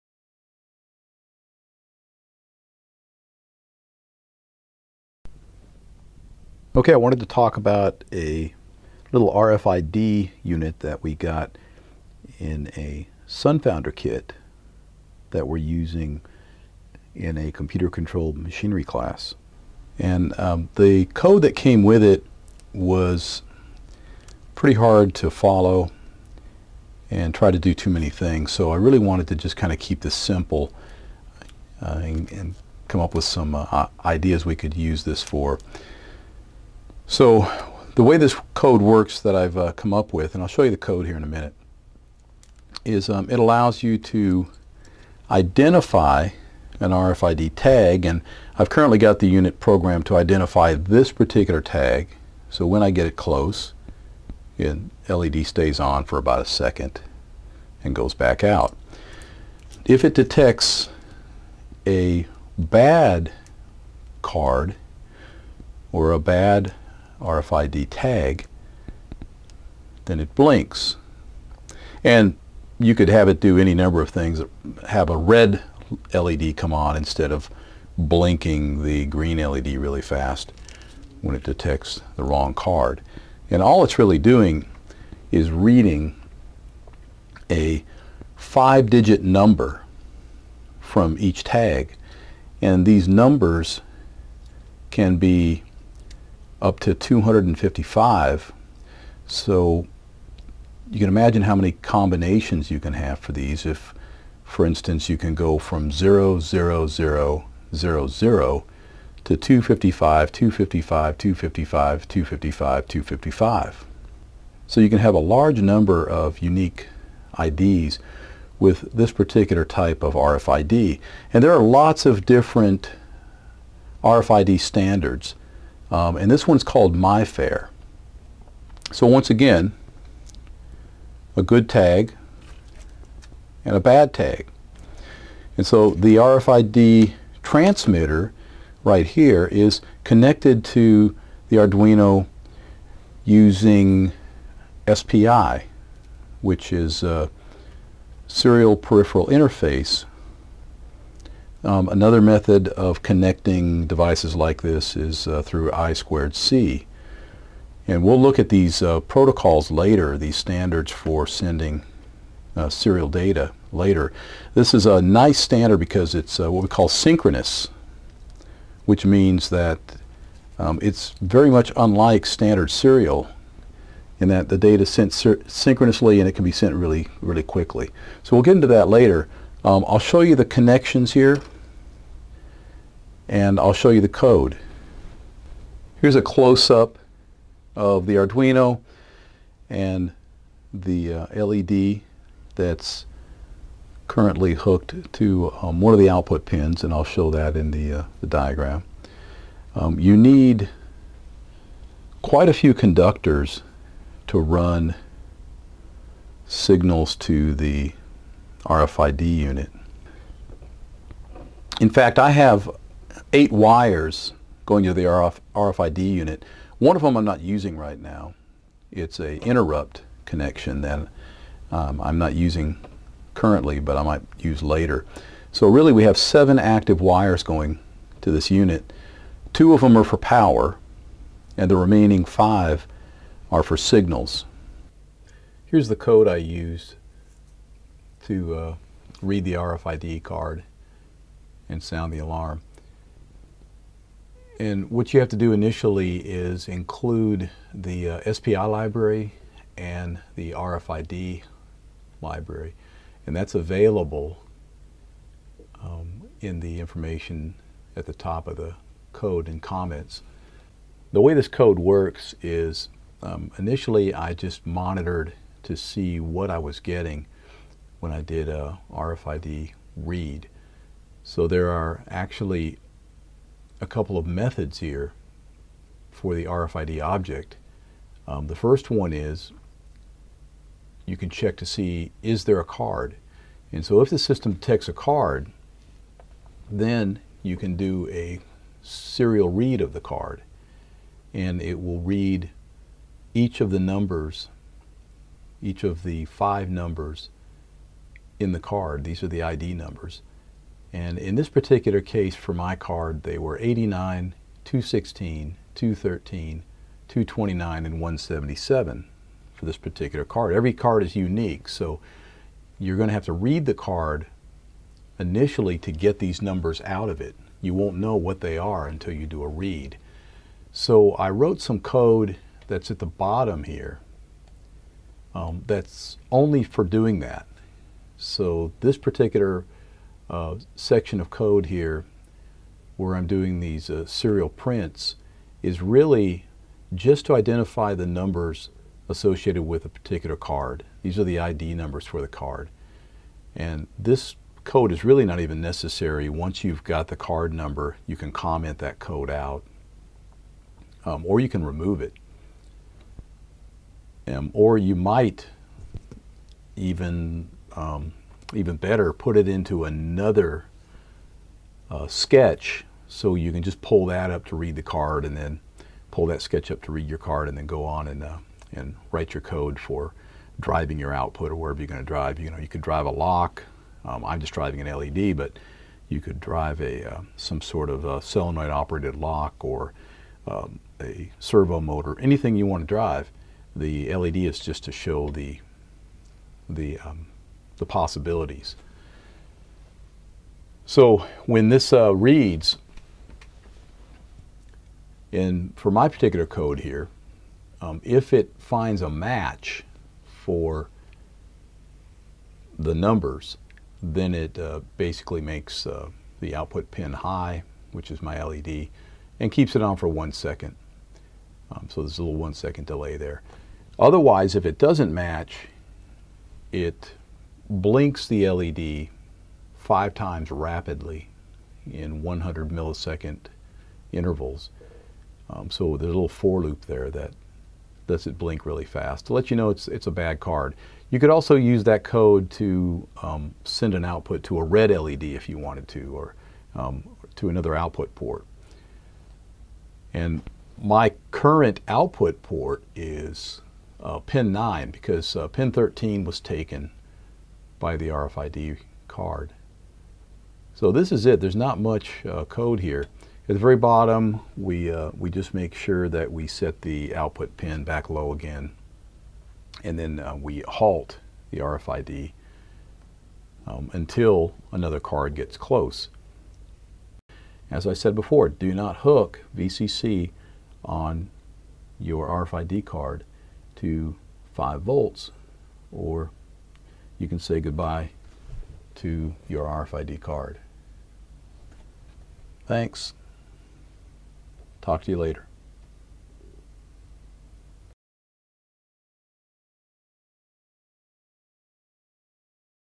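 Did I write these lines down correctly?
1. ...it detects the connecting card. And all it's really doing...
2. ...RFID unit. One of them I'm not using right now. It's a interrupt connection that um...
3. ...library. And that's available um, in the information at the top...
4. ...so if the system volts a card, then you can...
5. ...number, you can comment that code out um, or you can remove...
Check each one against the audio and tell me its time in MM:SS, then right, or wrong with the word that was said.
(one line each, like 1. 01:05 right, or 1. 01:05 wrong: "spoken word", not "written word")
1. 01:21 wrong: "wrong", not "connecting"
2. 03:35 right
3. 04:12 right
4. 04:43 wrong: "detects", not "volts"
5. 05:47 right.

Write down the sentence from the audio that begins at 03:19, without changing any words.
Um, you need quite a few conductors to run signals to the RFID unit.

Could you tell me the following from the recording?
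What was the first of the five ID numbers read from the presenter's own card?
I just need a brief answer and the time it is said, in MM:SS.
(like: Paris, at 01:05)
89, at 05:03.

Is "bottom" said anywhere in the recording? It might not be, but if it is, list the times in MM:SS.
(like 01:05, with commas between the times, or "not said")
05:23, 07:33.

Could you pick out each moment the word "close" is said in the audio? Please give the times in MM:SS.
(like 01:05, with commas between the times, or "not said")
00:53, 03:06, 07:45.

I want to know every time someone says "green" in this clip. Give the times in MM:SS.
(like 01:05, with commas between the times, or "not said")
01:19.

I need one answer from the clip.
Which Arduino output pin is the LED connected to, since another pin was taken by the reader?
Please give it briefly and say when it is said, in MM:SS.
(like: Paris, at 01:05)
pin 9, at 07:24.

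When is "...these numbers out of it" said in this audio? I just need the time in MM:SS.
05:16.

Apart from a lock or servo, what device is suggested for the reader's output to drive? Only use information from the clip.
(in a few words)
solenoid operated lock.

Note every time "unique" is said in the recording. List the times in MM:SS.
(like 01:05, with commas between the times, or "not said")
01:56, 05:11.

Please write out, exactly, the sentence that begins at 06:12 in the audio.
You know, you could drive a lock.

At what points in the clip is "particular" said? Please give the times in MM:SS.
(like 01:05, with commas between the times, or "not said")
00:51, 01:59, 05:01, 05:09, 05:28, 05:39, 06:36.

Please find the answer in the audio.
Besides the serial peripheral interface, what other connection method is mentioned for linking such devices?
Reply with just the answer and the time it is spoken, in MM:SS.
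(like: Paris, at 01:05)
I squared C, at 02:35.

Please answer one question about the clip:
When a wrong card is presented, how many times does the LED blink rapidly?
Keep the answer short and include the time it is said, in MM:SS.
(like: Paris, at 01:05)
5, at 06:59.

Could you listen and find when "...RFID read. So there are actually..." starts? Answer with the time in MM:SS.
04:28.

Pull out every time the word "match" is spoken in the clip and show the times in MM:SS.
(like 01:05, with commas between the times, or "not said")
06:39, 06:55.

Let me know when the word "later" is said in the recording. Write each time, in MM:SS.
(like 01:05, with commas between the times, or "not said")
02:39, 02:43, 02:58, 03:44, 08:05.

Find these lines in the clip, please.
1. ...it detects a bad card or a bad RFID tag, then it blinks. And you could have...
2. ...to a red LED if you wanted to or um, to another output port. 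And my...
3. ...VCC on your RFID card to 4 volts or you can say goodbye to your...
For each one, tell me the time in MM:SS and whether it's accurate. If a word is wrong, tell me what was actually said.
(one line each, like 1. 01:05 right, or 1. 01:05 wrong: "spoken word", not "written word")
1. 01:00 right
2. 07:14 right
3. 07:49 wrong: "5", not "4".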